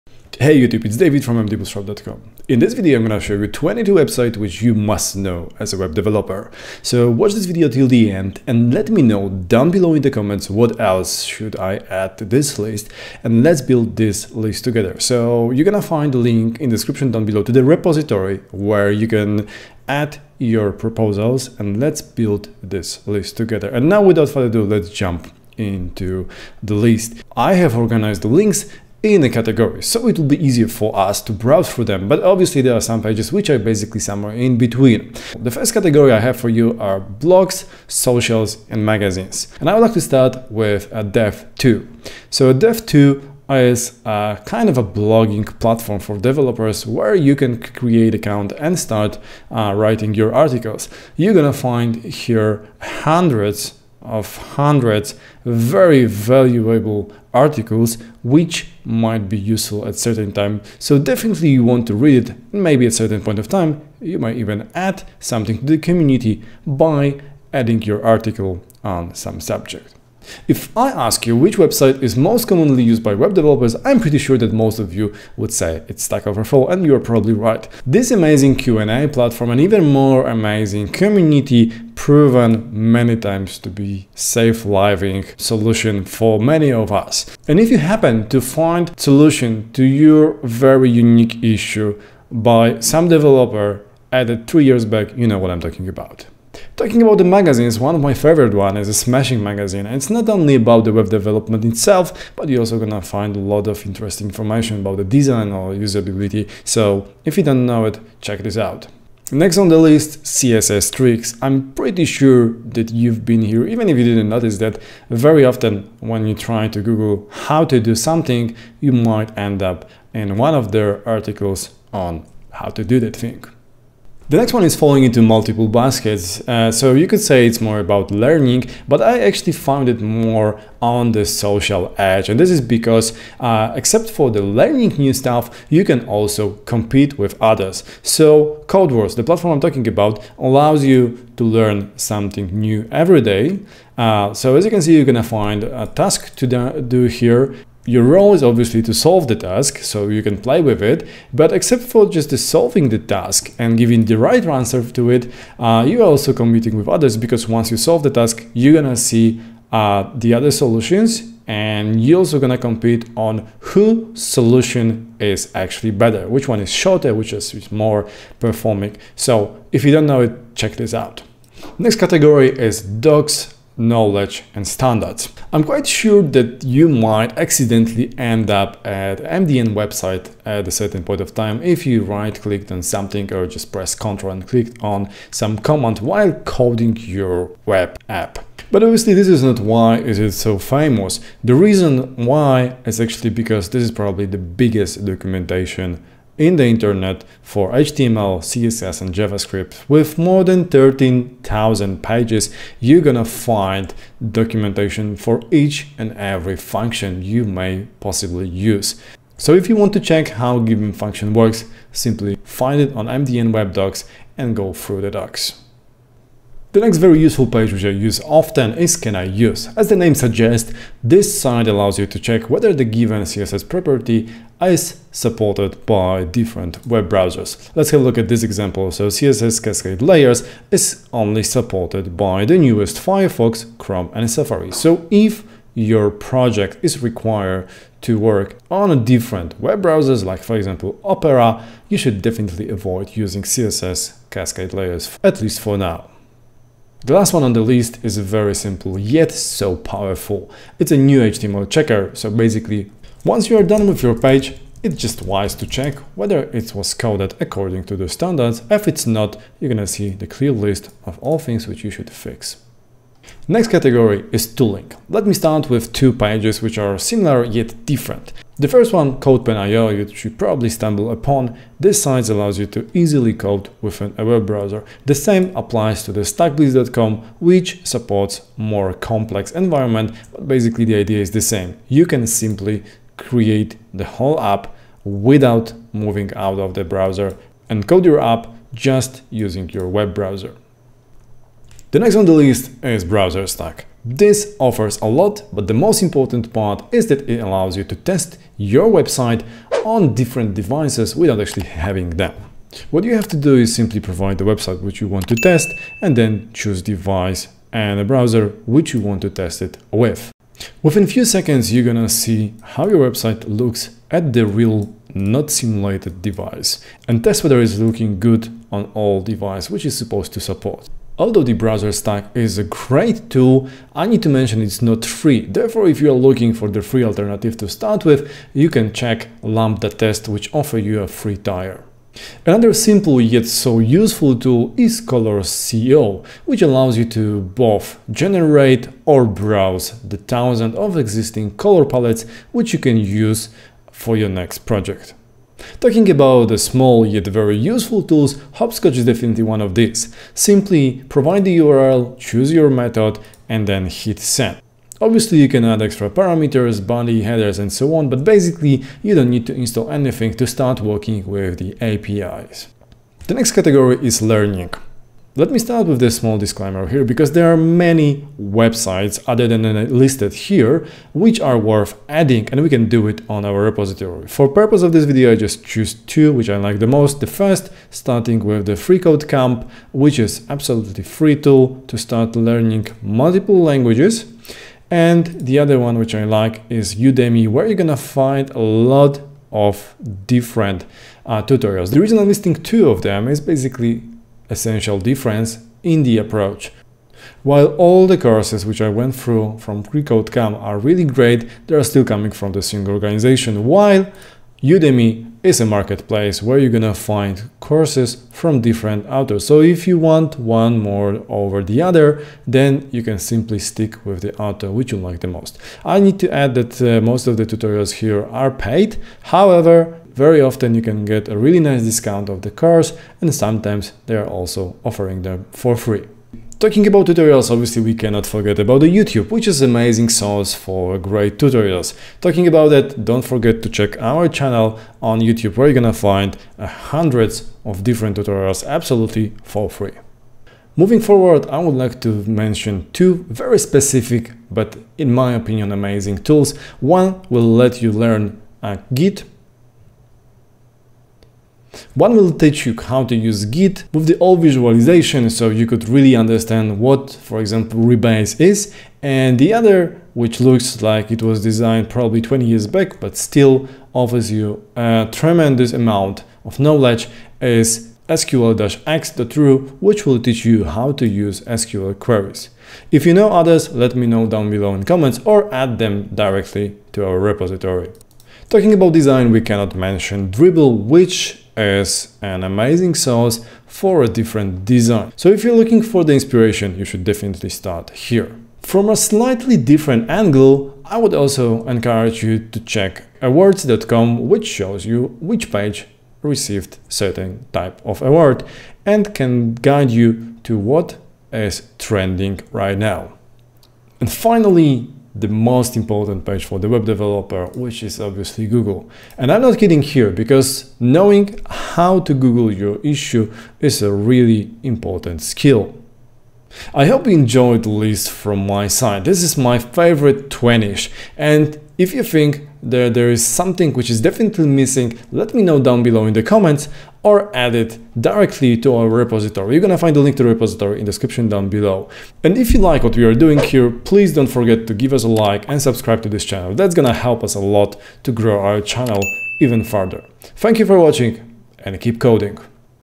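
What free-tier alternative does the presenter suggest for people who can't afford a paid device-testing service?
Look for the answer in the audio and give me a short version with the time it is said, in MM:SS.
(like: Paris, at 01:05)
LambdaTest, at 05:29.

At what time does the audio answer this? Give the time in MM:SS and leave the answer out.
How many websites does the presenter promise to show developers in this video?
00:03.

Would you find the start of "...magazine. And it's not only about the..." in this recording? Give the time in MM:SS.
01:39.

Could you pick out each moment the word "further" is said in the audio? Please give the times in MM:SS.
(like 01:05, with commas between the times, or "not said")
00:24, 08:59.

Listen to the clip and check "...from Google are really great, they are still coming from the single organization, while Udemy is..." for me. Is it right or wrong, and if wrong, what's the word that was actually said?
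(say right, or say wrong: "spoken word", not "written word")
wrong: "FreeCodeCamp", not "Google".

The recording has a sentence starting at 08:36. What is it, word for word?
I hope you enjoyed the list from my side.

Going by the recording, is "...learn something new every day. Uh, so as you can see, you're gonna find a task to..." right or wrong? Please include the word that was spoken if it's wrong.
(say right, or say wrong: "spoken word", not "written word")
right.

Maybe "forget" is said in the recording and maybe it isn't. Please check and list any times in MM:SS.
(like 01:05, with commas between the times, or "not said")
07:08, 07:13, 08:54.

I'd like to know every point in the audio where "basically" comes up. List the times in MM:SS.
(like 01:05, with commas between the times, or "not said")
00:33, 04:12, 04:40, 05:58, 06:33.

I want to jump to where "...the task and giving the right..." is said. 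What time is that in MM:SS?
02:32.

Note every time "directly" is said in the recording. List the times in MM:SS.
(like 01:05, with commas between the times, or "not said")
07:56, 08:47.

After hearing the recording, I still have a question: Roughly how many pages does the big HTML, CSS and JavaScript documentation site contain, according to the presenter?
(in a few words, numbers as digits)
13,000.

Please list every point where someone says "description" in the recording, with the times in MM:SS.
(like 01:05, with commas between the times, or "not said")
00:16, 08:50.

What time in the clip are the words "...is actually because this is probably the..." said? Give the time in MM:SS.
03:12.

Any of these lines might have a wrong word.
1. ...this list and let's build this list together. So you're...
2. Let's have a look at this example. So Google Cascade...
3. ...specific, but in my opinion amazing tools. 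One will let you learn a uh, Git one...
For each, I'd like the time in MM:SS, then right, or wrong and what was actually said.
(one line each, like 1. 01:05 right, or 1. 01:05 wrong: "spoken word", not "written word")
1. 00:12 right
2. 03:47 wrong: "CSS", not "Google"
3. 07:23 right.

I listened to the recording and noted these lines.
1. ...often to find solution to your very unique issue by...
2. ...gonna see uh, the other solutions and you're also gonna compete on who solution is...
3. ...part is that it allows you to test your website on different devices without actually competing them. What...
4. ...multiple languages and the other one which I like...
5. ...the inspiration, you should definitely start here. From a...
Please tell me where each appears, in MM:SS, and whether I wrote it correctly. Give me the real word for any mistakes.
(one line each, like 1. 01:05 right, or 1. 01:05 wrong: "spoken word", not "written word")
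1. 01:27 wrong: "happen", not "often"
2. 02:38 right
3. 04:56 wrong: "having", not "competing"
4. 06:23 right
5. 08:06 right.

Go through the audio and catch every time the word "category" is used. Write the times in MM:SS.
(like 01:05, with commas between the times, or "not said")
00:29, 00:35, 02:51, 04:23, 06:03.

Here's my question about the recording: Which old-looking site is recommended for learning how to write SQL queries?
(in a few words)
sql-ex.ru.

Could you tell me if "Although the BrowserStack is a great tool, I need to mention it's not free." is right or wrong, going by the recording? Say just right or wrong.
right.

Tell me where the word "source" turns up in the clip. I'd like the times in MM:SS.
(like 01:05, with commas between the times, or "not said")
07:10, 08:02.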